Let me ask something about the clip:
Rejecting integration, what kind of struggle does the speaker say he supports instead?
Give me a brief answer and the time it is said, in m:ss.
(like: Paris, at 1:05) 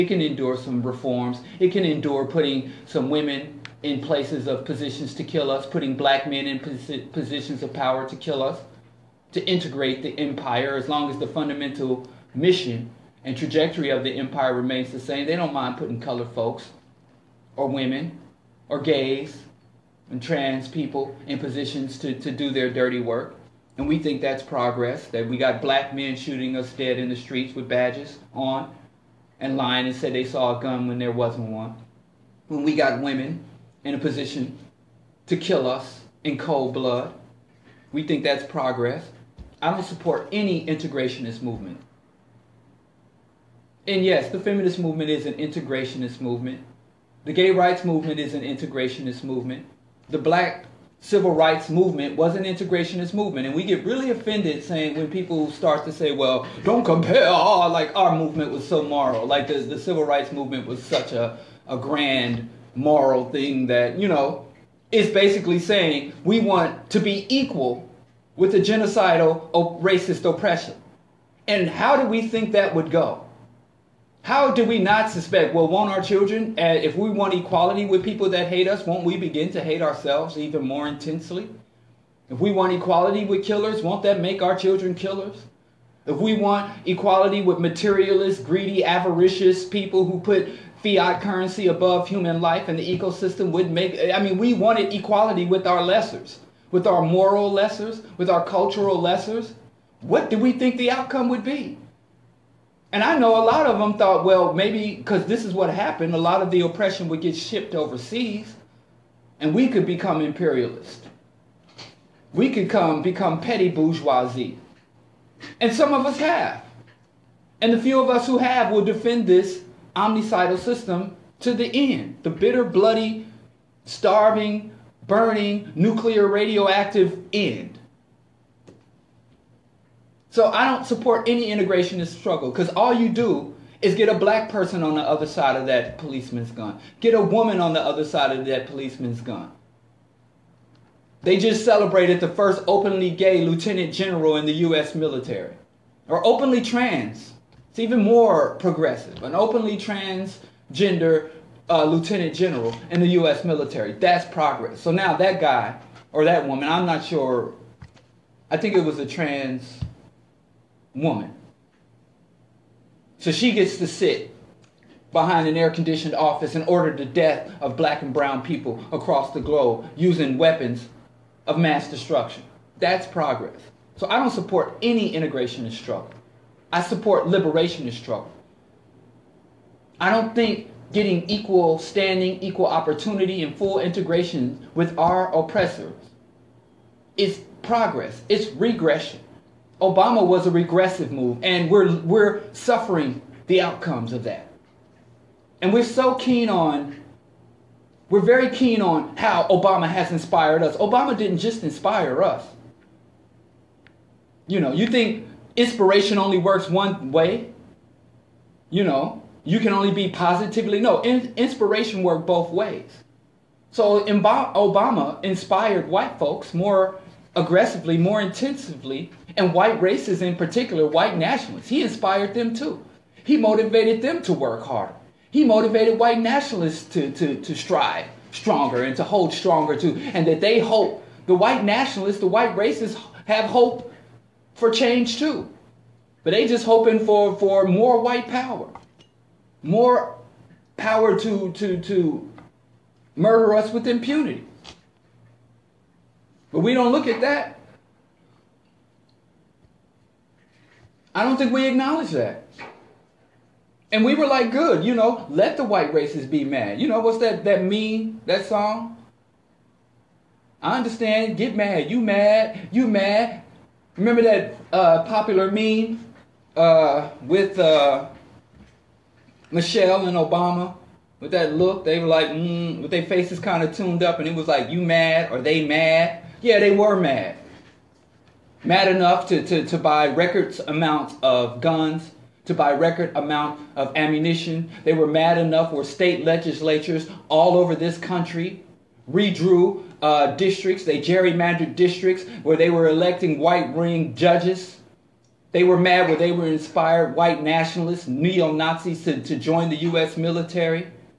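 liberationist struggle, at 2:57.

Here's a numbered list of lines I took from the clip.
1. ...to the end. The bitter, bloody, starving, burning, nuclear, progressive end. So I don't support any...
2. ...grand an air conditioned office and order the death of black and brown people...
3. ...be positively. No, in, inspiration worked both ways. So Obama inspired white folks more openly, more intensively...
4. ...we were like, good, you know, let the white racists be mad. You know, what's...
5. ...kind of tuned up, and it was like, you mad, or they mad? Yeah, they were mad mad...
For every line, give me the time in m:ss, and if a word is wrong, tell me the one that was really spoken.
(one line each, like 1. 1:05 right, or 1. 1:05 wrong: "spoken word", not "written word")
1. 2:01 wrong: "radioactive", not "progressive"
2. 2:45 wrong: "behind", not "grand"
3. 3:29 wrong: "aggressively", not "openly"
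4. 4:14 right
5. 4:33 right.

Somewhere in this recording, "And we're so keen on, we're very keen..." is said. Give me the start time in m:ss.
3:15.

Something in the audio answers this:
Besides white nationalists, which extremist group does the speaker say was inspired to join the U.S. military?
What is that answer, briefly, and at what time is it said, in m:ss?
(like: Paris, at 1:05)
neo-Nazis, at 4:58.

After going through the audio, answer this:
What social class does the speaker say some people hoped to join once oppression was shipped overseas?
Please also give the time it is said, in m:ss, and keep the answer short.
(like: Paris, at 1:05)
petty bourgeoisie, at 1:53.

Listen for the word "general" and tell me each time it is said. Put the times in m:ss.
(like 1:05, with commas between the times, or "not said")
2:23, 2:32.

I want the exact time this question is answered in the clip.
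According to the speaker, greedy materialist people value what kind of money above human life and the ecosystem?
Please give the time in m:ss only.
1:30.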